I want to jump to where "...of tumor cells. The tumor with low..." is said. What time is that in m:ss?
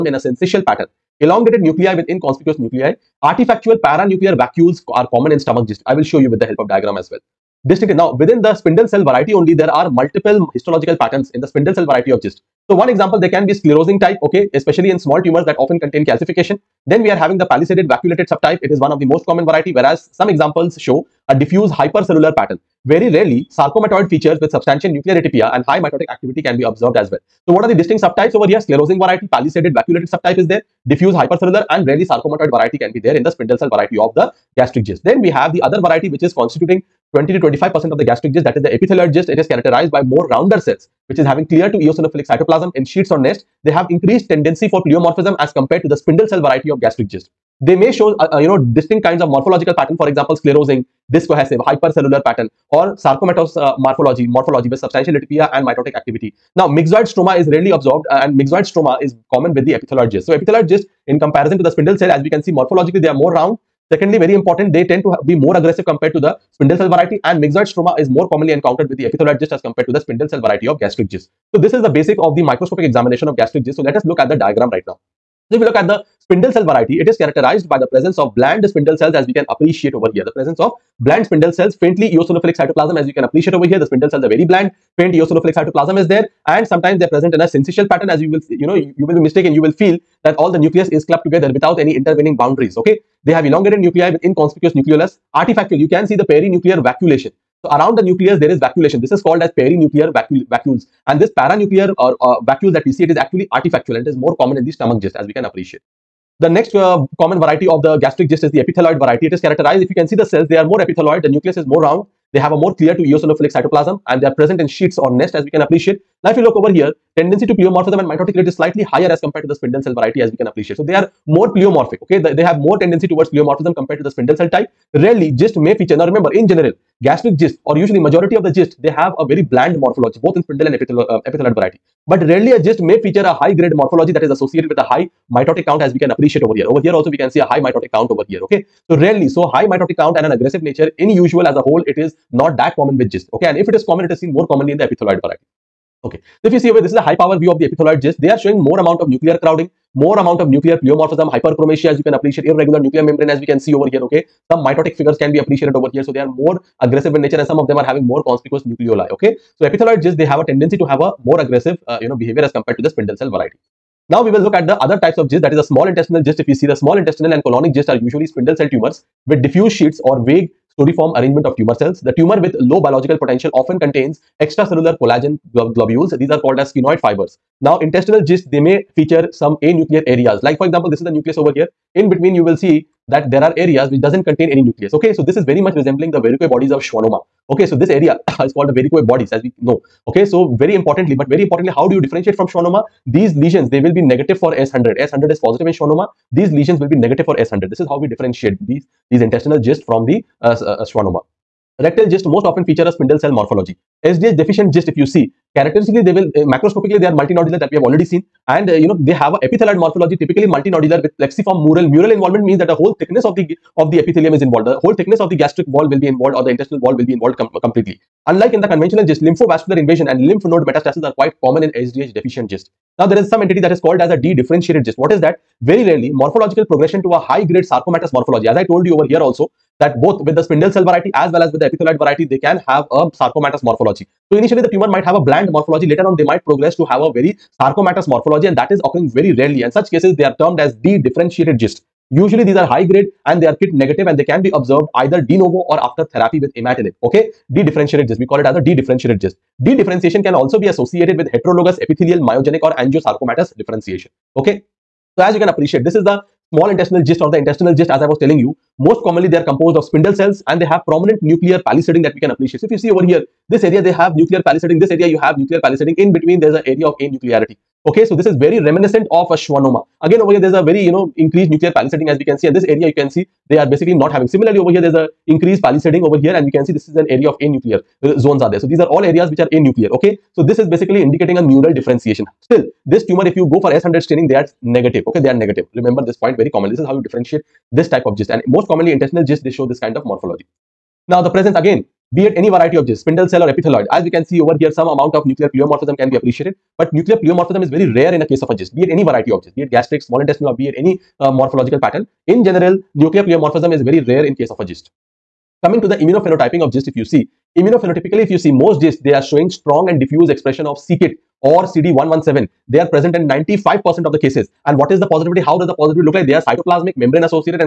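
2:51.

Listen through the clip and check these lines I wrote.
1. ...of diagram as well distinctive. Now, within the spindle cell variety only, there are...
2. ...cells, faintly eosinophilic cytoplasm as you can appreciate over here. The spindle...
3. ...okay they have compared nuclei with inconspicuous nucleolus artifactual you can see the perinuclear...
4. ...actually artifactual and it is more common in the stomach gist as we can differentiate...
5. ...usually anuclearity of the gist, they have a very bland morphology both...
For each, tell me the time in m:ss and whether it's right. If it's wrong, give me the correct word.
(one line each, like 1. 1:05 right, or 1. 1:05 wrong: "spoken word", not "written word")
1. 0:06 right
2. 1:21 right
3. 1:32 wrong: "elongated", not "compared"
4. 1:43 wrong: "appreciate", not "differentiate"
5. 2:07 wrong: "majority", not "anuclearity".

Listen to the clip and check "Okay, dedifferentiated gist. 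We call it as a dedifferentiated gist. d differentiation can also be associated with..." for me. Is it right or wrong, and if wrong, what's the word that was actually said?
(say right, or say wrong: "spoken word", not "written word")
right.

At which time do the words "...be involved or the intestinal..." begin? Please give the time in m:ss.
3:35.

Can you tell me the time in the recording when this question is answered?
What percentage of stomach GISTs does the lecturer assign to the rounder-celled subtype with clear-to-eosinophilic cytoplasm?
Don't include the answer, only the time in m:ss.
0:37.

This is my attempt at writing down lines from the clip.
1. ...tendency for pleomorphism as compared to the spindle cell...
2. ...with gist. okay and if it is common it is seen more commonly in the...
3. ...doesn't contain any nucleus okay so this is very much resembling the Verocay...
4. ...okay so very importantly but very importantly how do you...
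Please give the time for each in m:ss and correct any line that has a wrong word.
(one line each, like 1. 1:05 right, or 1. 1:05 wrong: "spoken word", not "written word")
1. 0:44 right
2. 2:22 right
3. 3:04 right
4. 3:10 right.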